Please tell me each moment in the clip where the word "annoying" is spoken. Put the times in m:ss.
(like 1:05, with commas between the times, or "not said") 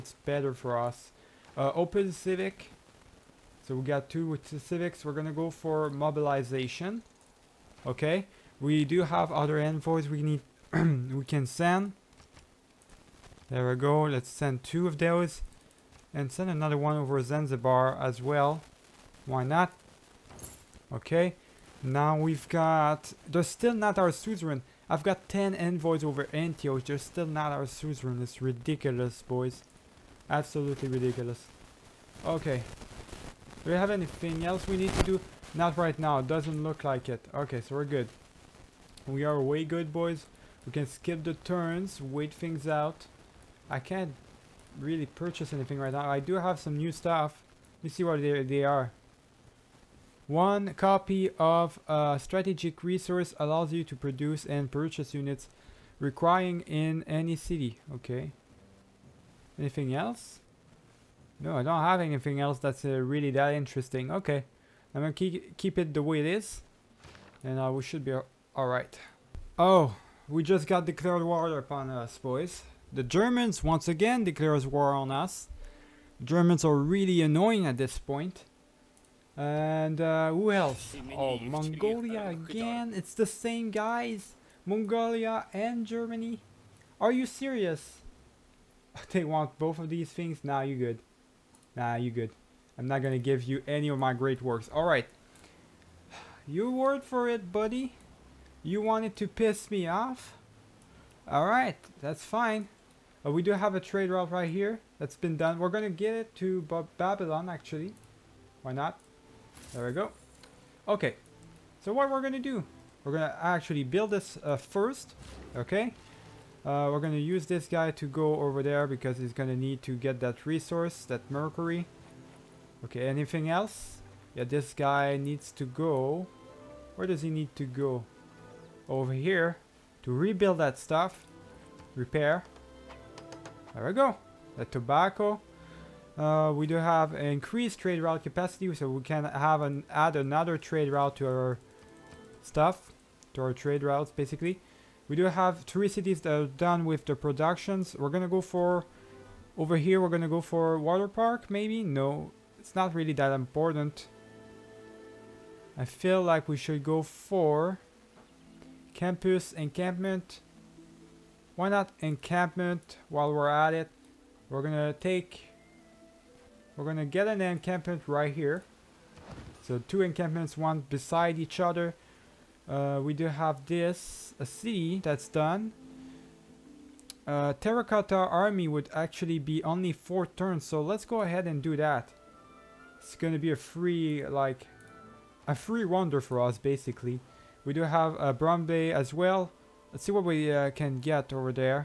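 1:17.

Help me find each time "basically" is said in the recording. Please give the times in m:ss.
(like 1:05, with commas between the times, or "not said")
2:24, 3:06.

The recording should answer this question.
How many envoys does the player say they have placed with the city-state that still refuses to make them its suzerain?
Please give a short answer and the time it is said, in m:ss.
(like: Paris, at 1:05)
10, at 0:25.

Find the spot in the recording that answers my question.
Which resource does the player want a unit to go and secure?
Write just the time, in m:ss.
2:01.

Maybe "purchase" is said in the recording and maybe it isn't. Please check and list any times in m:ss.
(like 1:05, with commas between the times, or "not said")
0:45, 0:54.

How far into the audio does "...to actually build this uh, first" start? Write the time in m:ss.
1:53.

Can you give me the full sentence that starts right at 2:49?
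So two encampments, one beside each other.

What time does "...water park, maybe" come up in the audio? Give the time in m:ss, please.
2:30.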